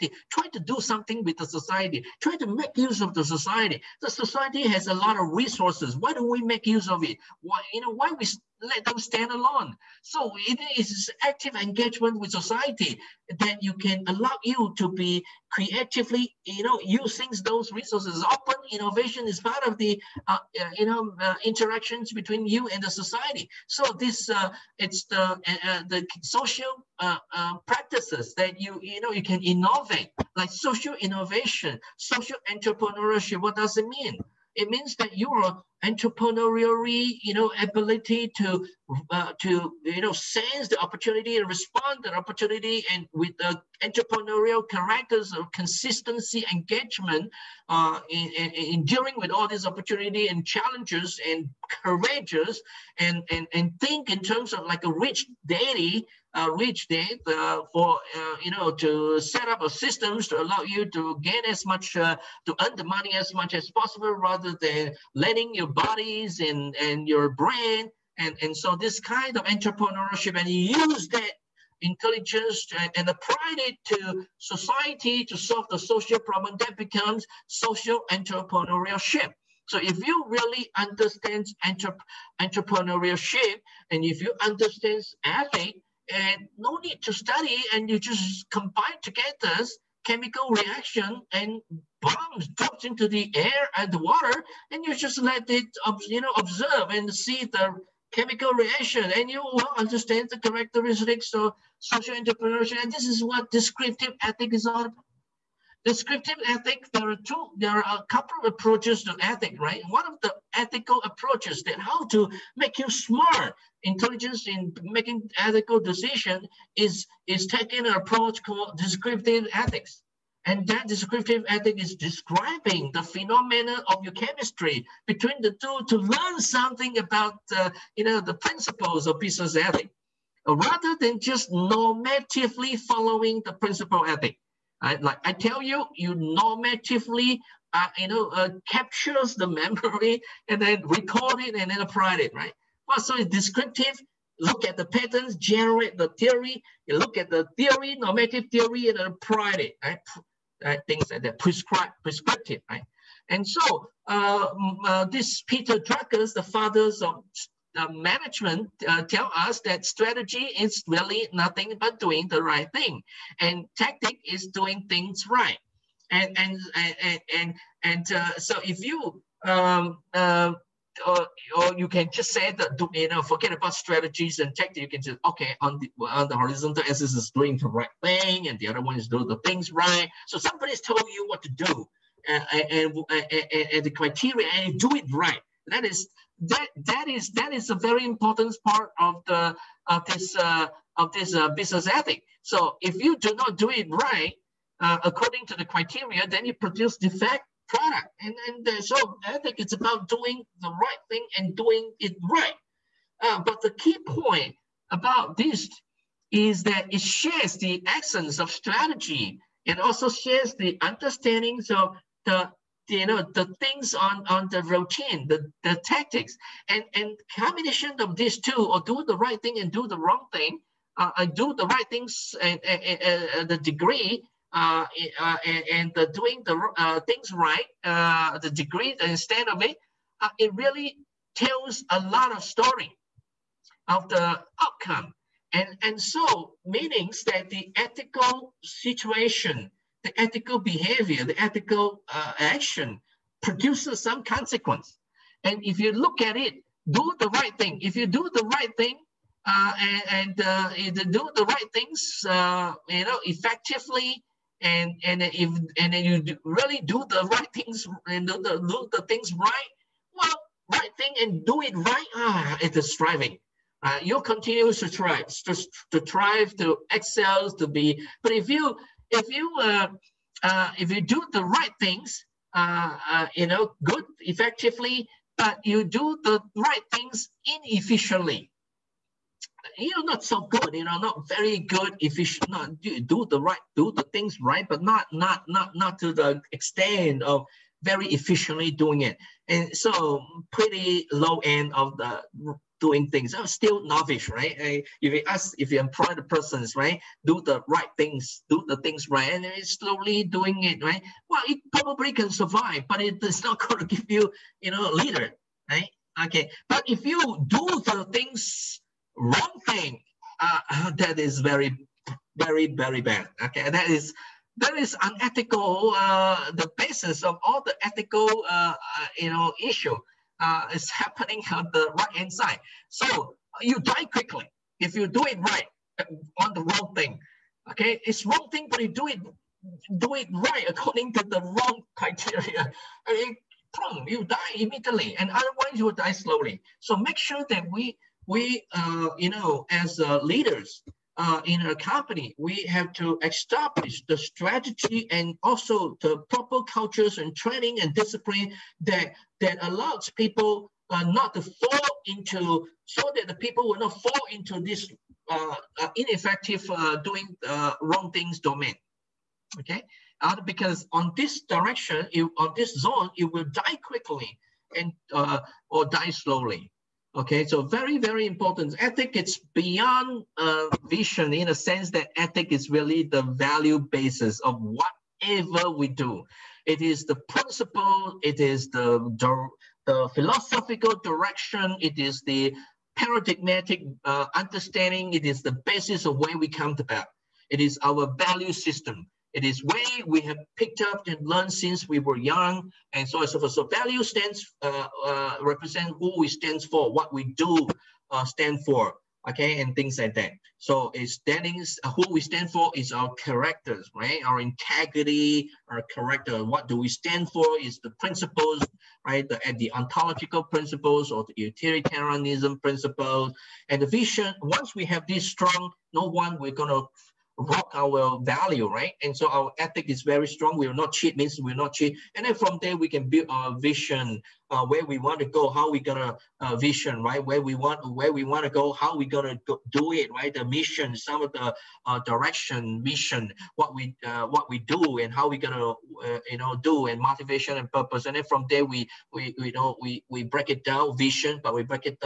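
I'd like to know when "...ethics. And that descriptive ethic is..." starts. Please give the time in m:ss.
1:59.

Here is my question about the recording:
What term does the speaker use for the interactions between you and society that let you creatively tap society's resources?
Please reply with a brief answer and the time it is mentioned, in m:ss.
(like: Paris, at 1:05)
Open innovation, at 0:18.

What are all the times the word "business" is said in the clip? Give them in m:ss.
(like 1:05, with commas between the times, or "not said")
2:09, 3:11.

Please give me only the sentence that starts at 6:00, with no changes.
because on this direction, it, on this zone, it will die quickly and or die slowly.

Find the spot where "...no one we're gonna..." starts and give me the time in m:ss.
6:55.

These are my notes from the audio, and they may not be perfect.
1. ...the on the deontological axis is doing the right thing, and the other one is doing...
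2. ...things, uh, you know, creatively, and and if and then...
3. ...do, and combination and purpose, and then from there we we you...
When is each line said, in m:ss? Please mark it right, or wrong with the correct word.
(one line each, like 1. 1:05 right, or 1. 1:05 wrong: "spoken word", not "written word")
1. 2:55 wrong: "horizontal", not "deontological"
2. 4:11 wrong: "effectively", not "creatively"
3. 7:16 wrong: "motivation", not "combination".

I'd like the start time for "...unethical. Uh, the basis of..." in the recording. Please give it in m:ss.
5:15.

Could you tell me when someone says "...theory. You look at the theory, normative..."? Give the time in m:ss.
2:26.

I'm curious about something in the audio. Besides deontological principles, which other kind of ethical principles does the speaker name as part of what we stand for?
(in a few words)
utilitarianism.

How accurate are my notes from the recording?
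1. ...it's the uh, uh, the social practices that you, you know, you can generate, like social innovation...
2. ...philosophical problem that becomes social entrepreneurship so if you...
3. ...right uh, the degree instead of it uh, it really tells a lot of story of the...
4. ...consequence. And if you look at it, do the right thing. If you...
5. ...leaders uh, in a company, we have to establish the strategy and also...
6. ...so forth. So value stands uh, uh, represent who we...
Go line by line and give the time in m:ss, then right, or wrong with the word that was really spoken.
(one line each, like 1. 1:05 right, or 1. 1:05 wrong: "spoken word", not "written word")
1. 0:24 wrong: "innovate", not "generate"
2. 1:15 wrong: "social", not "philosophical"
3. 3:47 right
4. 4:04 right
5. 5:40 right
6. 6:33 right.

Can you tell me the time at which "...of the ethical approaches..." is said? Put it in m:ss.
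1:50.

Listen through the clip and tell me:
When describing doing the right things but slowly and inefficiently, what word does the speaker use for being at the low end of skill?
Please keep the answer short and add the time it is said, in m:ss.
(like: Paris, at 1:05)
novice, at 4:53.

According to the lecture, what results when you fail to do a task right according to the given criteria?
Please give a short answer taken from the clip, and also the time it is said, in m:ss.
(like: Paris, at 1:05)
defect product, at 3:16.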